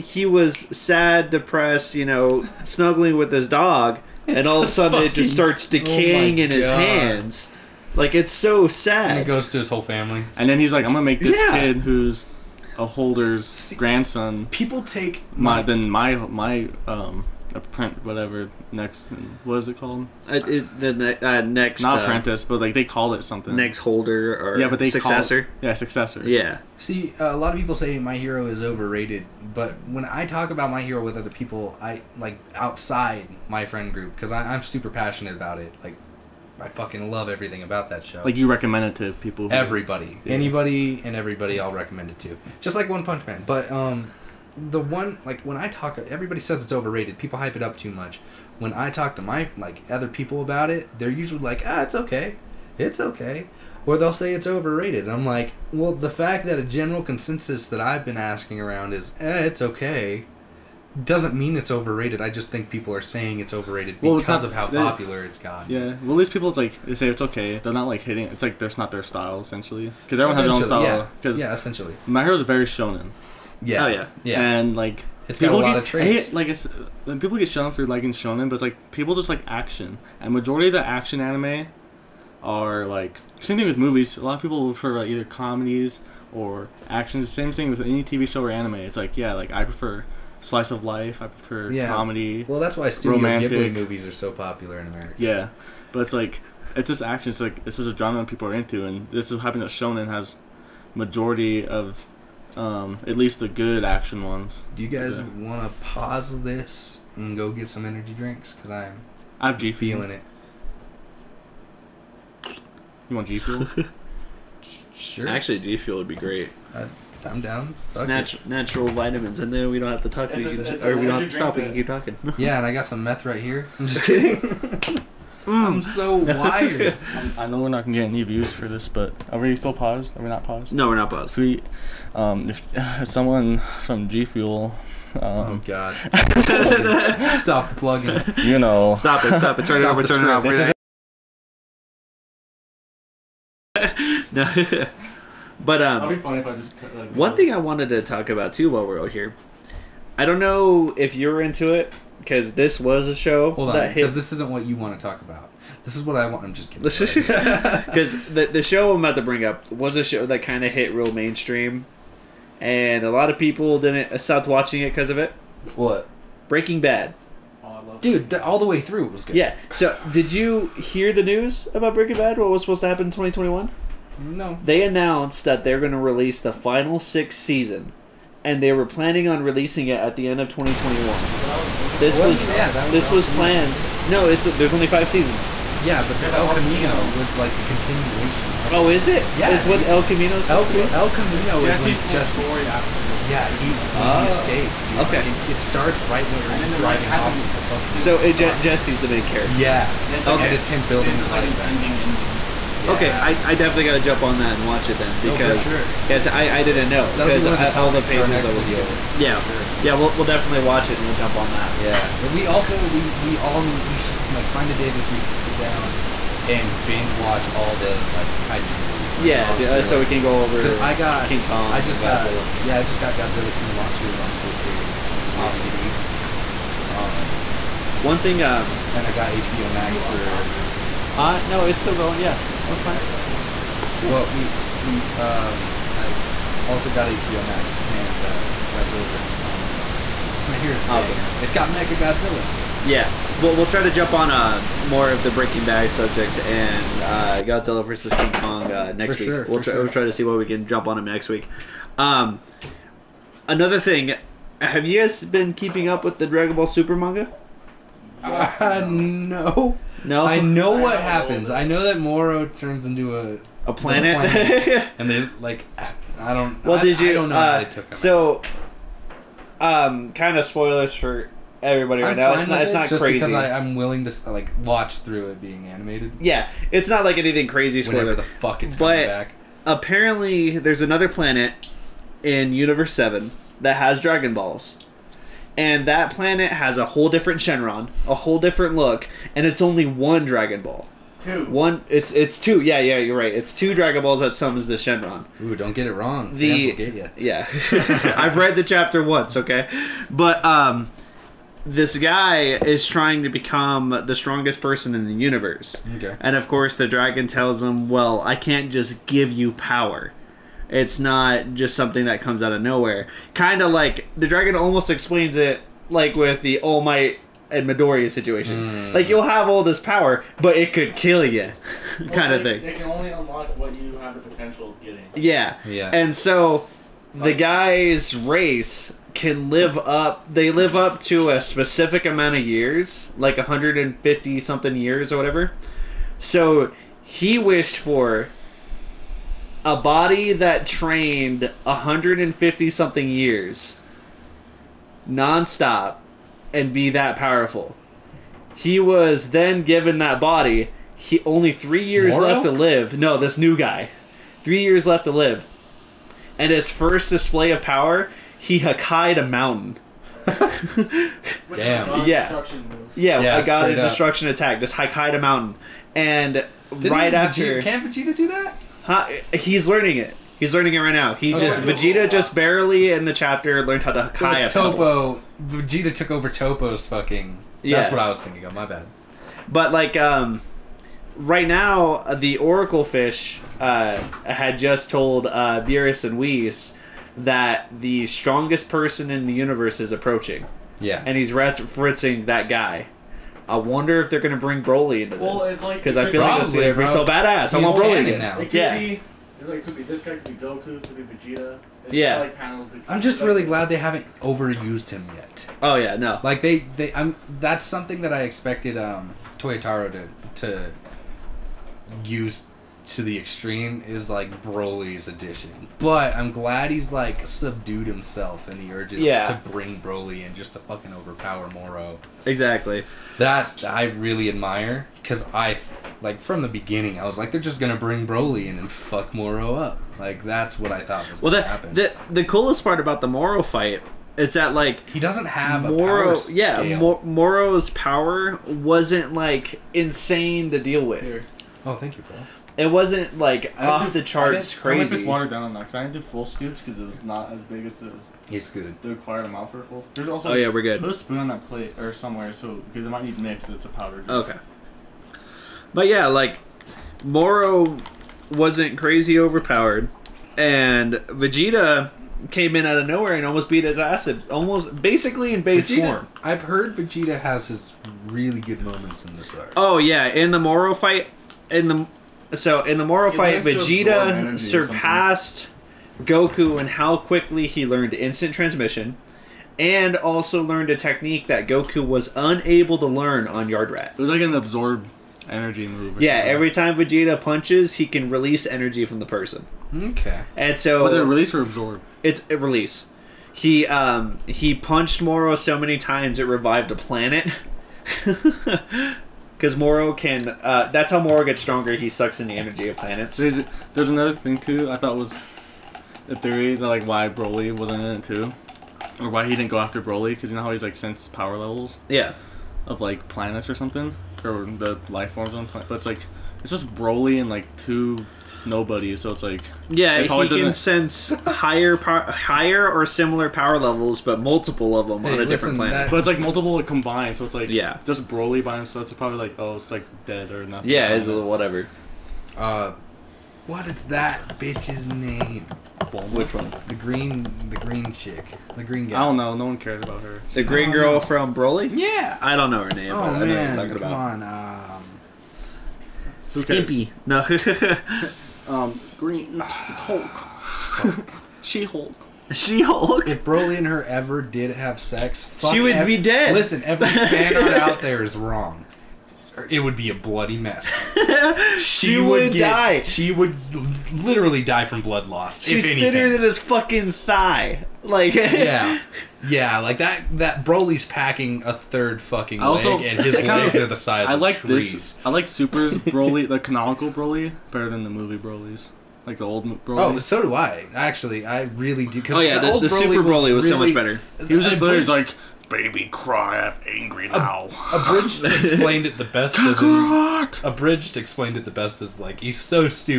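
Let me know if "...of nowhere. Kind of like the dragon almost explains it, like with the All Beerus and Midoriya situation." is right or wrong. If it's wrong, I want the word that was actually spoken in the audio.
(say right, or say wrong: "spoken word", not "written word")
wrong: "Might", not "Beerus".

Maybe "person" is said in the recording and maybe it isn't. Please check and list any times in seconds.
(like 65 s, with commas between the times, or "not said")
304 s, 388 s, 489 s.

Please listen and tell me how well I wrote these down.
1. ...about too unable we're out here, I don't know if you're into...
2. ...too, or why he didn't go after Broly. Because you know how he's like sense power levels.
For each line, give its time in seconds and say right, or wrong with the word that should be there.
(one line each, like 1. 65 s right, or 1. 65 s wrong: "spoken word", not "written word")
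1. 148 s wrong: "while", not "unable"
2. 508 s right.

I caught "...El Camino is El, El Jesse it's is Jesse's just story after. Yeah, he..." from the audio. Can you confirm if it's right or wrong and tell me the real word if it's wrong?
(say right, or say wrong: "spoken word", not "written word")
wrong: "Camino", not "Jesse".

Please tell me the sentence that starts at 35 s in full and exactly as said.
Like I fucking love everything about that show.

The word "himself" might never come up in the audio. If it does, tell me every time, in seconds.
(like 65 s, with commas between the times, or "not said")
417 s, 528 s.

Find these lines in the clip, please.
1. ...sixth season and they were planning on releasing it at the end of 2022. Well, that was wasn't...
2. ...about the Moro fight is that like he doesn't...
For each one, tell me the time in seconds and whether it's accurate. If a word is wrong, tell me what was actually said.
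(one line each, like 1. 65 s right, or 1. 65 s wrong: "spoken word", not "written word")
1. 176 s wrong: "2021", not "2022"
2. 432 s right.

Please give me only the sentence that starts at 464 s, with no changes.
Almost basically in base Vegeta, form.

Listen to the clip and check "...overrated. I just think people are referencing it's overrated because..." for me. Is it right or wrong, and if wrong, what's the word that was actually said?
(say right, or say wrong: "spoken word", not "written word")
wrong: "saying", not "referencing".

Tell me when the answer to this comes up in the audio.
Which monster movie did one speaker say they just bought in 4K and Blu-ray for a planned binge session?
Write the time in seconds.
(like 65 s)
223 s.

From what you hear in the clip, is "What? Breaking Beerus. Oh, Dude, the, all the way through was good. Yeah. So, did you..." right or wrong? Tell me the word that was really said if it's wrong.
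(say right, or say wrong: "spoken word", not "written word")
wrong: "Bad", not "Beerus".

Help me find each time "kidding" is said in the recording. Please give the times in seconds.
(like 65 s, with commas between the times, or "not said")
124 s, 156 s.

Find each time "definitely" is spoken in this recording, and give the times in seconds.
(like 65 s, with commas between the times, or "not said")
203 s, 210 s.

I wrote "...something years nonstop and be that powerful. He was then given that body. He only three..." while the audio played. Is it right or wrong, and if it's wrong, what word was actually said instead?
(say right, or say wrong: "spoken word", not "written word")
right.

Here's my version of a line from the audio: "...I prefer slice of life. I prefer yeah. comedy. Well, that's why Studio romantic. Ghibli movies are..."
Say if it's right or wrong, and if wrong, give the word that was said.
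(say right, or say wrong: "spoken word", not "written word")
right.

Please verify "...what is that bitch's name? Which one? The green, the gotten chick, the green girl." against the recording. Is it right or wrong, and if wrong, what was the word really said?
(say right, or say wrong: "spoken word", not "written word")
wrong: "green", not "gotten".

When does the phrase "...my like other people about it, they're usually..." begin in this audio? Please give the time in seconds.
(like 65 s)
49 s.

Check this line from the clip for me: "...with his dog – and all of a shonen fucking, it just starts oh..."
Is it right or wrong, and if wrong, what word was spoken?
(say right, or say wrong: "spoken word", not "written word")
wrong: "sudden", not "shonen".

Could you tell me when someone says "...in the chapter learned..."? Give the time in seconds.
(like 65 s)
372 s.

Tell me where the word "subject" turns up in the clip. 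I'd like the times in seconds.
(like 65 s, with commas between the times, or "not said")
245 s.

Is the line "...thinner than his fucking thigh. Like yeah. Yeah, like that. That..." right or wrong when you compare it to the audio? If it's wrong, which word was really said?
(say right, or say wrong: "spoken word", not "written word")
right.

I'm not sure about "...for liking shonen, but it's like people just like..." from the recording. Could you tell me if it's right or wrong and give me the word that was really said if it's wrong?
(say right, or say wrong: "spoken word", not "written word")
right.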